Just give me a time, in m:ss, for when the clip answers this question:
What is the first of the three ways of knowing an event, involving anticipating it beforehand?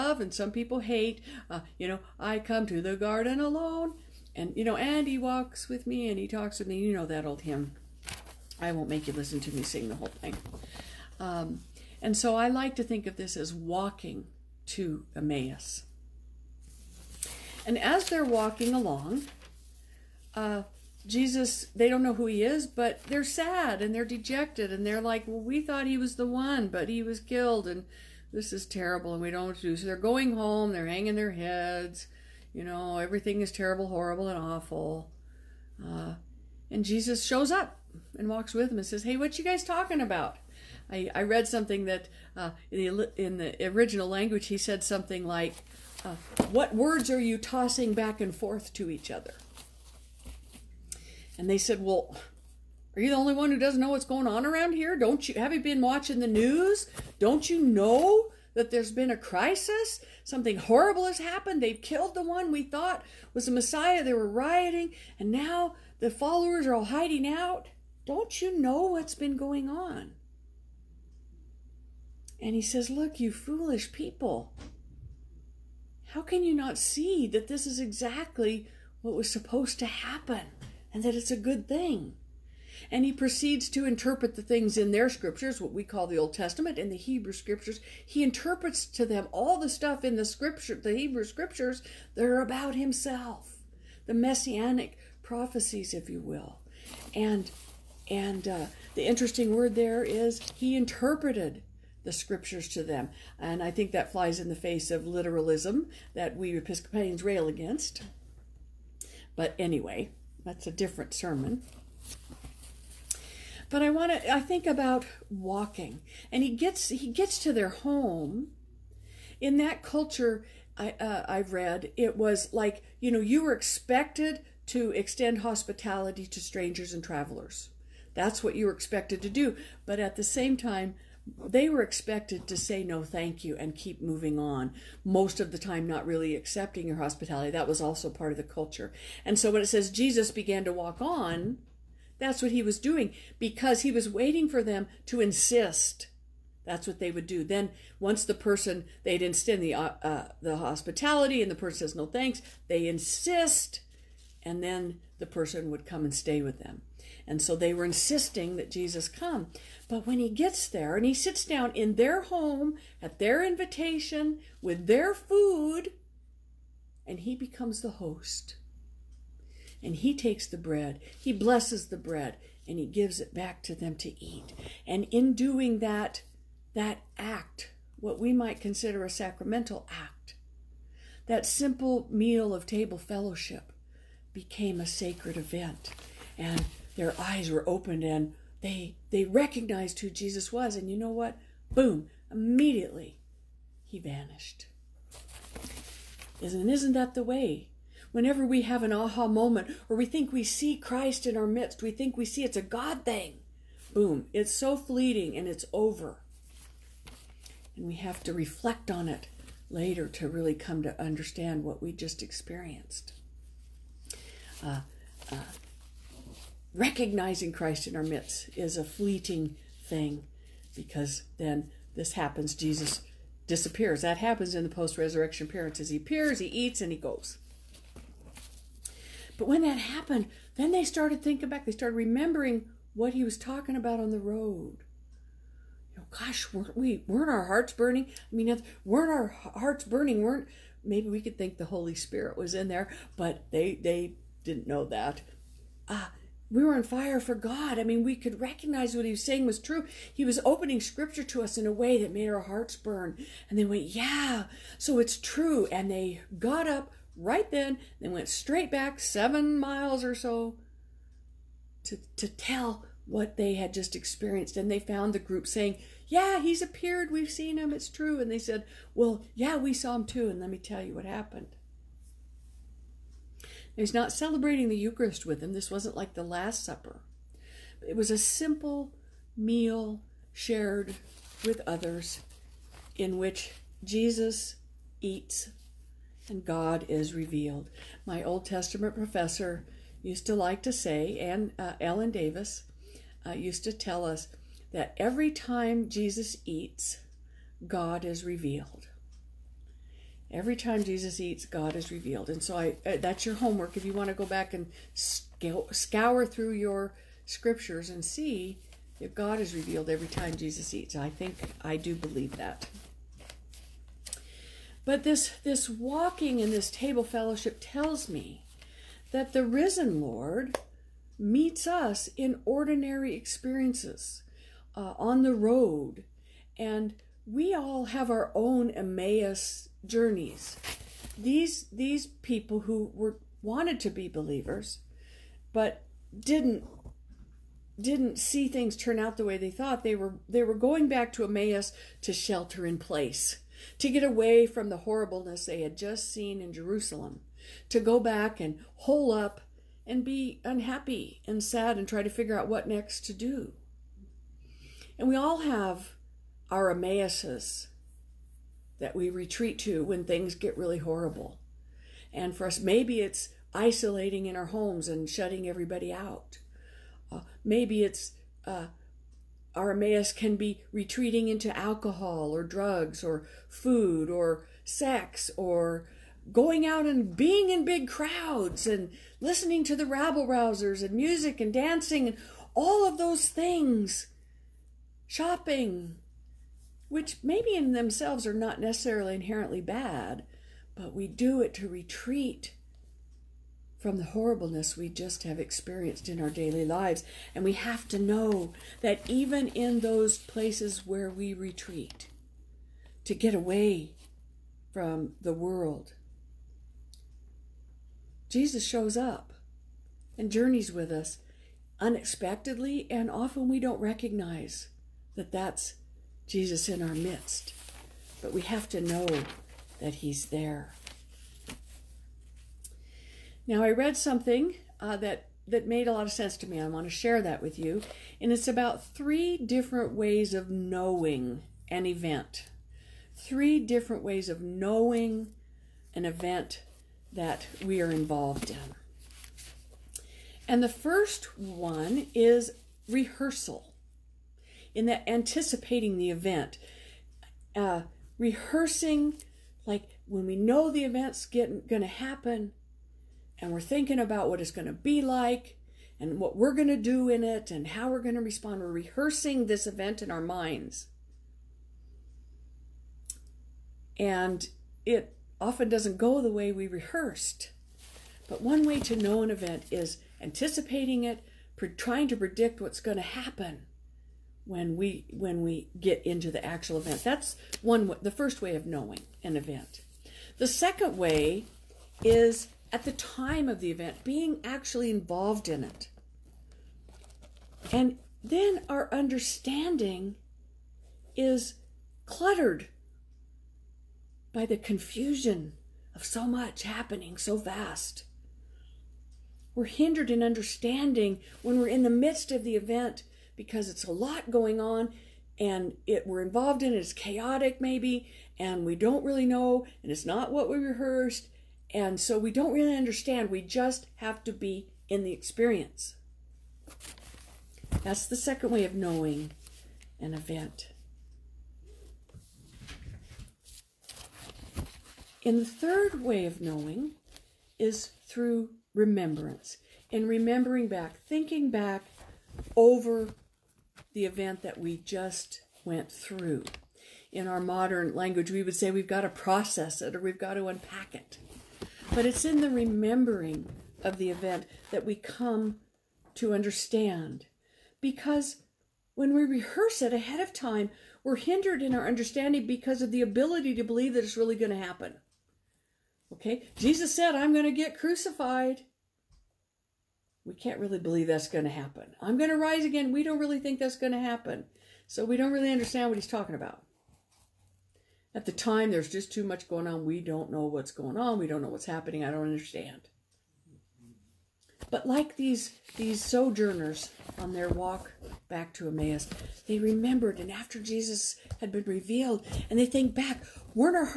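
7:22.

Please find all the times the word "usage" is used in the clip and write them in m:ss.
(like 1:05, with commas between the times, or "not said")
not said.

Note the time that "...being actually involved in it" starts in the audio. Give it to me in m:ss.
8:04.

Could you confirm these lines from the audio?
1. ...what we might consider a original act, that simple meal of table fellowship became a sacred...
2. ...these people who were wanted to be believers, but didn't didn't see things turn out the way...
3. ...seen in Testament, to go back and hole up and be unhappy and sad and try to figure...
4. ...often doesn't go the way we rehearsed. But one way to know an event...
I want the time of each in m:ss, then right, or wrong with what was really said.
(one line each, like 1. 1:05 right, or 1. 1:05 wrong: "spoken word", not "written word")
1. 2:57 wrong: "sacramental", not "original"
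2. 5:31 right
3. 5:46 wrong: "Jerusalem", not "Testament"
4. 7:45 right.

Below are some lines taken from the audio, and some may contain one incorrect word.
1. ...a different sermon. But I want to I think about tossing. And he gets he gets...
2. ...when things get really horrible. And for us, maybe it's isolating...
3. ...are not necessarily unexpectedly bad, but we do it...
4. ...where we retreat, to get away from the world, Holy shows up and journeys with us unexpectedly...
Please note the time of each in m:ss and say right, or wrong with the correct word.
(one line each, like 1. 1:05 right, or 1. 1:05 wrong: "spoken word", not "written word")
1. 1:50 wrong: "walking", not "tossing"
2. 5:59 right
3. 6:28 wrong: "inherently", not "unexpectedly"
4. 6:40 wrong: "Jesus", not "Holy".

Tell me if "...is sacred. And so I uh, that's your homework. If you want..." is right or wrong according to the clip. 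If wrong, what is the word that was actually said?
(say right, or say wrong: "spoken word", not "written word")
wrong: "revealed", not "sacred".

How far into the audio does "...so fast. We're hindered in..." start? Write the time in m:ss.
8:17.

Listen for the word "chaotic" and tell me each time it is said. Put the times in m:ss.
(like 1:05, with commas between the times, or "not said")
8:26.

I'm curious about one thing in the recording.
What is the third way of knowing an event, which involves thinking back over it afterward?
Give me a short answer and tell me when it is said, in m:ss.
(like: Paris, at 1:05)
Remembrance, at 8:48.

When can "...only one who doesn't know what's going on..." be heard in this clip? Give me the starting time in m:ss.
0:53.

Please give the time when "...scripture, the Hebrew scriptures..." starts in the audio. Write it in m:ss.
1:30.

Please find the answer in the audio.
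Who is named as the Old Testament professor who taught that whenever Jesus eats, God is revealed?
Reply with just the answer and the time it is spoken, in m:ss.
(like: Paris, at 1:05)
Ellen Davis, at 4:51.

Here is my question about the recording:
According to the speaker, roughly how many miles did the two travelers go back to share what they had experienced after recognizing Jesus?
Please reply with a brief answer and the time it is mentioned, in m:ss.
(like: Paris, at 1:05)
7, at 4:18.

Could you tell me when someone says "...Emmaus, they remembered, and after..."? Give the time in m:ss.
9:38.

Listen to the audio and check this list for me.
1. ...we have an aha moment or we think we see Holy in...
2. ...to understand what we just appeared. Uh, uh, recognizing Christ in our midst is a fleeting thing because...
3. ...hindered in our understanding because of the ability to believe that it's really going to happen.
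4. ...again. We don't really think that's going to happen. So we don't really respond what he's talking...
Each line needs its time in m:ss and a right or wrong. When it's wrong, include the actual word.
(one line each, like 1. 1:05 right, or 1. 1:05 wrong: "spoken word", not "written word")
1. 3:18 wrong: "Christ", not "Holy"
2. 3:30 wrong: "experienced", not "appeared"
3. 9:11 right
4. 9:22 wrong: "understand", not "respond".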